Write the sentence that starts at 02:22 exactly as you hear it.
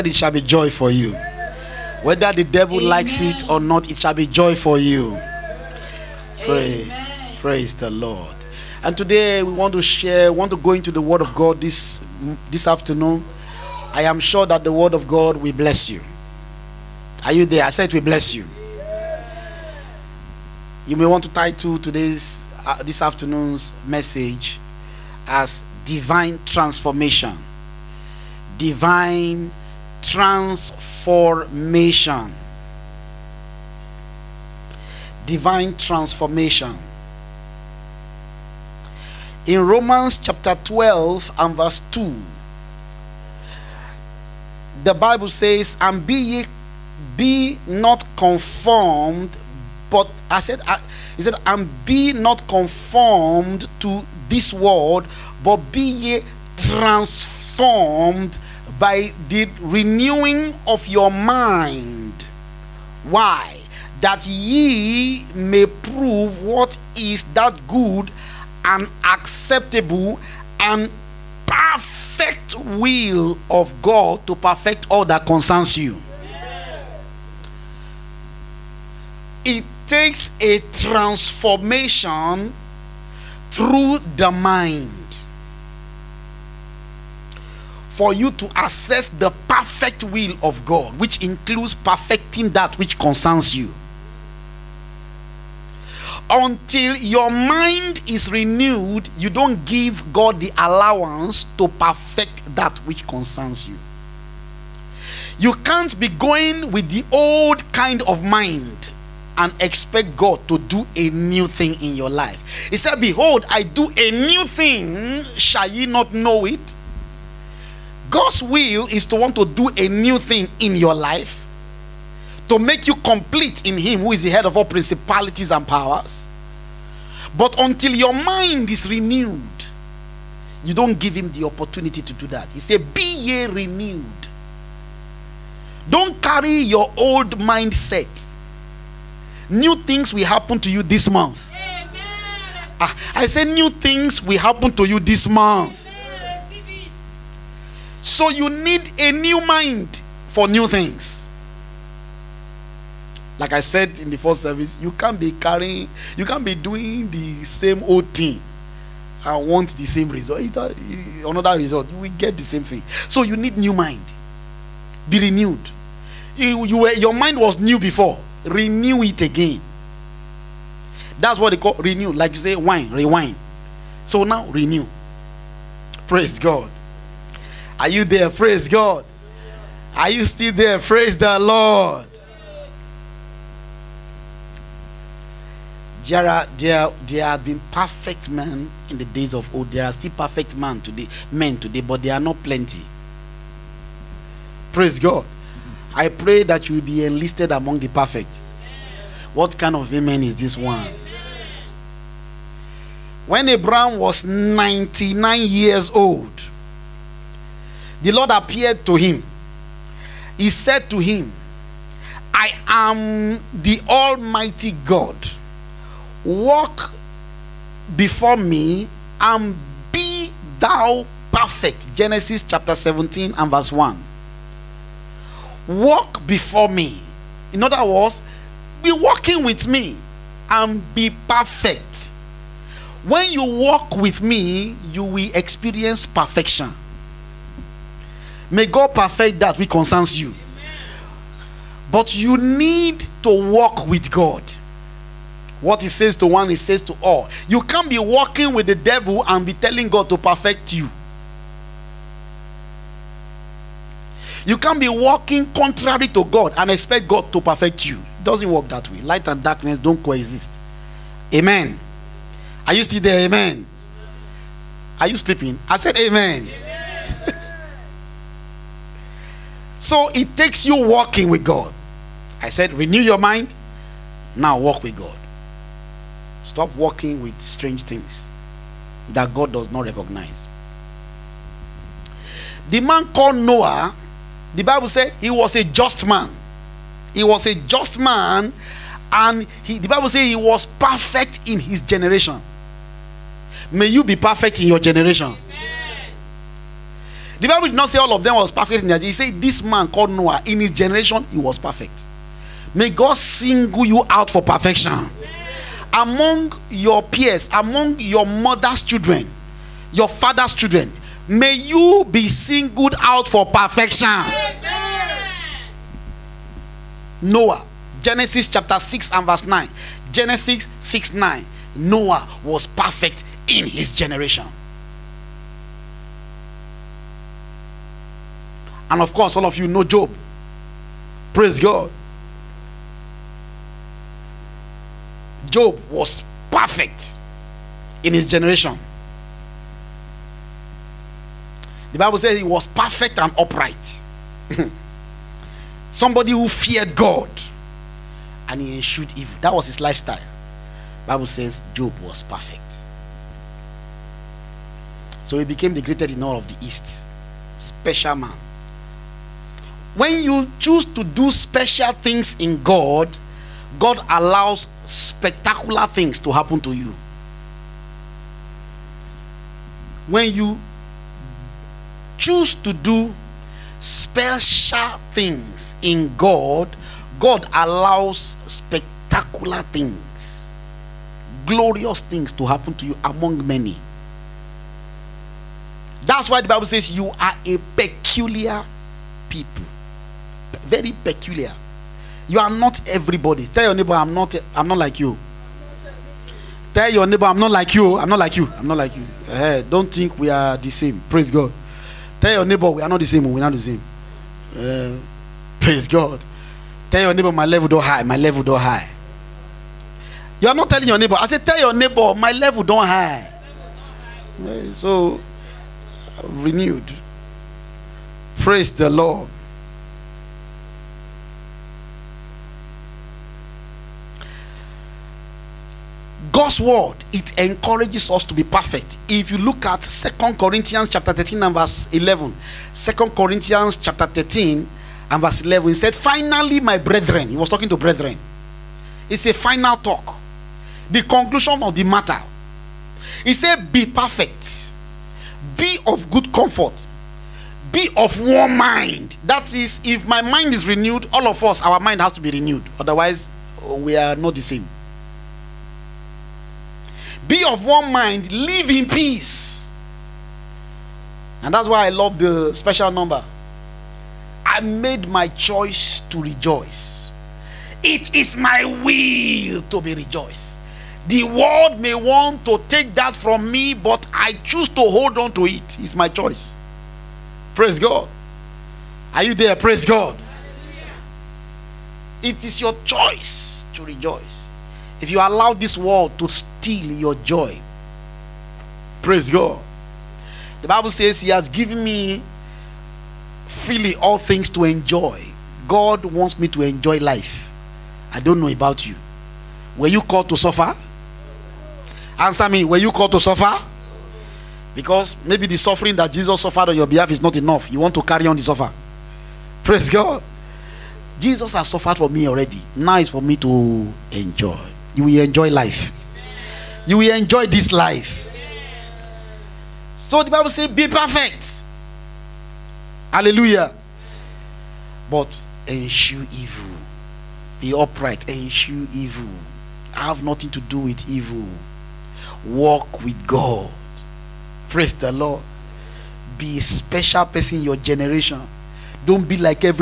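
Ah, I, I say, New things will happen to you this month.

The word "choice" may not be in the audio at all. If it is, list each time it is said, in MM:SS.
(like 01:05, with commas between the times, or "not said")
07:45, 07:56, 08:02.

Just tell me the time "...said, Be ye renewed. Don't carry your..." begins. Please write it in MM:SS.
02:12.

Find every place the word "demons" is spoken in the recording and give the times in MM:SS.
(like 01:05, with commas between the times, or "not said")
not said.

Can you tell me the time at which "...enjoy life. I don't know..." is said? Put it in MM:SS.
08:16.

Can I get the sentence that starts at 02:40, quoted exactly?
Uh, another result, we get the same thing.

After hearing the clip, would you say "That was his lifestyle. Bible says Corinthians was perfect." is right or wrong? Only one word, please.
wrong.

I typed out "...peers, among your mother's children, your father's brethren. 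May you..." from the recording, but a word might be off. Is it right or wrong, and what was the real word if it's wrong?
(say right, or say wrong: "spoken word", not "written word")
wrong: "children", not "brethren".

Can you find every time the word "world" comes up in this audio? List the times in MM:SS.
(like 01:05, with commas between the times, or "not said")
00:54, 07:51, 08:05.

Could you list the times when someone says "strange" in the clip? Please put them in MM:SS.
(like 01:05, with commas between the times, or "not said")
04:37.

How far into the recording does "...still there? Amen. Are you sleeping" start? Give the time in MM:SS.
04:22.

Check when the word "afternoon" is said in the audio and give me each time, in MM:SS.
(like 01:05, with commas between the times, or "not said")
00:12, 00:23.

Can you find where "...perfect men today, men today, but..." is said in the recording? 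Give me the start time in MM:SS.
03:10.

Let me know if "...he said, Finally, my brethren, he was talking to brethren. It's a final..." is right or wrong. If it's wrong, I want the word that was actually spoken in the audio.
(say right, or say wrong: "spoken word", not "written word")
right.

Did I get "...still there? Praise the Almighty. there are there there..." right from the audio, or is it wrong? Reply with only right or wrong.
wrong.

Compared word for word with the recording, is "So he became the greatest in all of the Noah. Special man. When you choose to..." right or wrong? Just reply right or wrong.
wrong.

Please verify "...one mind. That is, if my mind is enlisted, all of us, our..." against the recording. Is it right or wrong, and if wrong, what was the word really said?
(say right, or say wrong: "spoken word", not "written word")
wrong: "renewed", not "enlisted".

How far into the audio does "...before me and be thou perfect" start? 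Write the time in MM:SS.
03:37.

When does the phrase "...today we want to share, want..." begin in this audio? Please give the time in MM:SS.
00:08.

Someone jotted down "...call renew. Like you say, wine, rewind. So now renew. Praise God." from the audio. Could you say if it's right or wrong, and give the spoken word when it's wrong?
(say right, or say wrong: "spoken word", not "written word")
right.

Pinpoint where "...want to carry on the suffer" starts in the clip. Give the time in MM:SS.
08:27.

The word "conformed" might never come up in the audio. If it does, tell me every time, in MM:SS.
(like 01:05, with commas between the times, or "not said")
00:48, 00:52.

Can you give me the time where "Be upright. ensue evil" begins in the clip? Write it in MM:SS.
08:47.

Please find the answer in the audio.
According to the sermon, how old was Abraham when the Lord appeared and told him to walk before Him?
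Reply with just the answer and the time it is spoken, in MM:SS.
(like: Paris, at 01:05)
99, at 03:24.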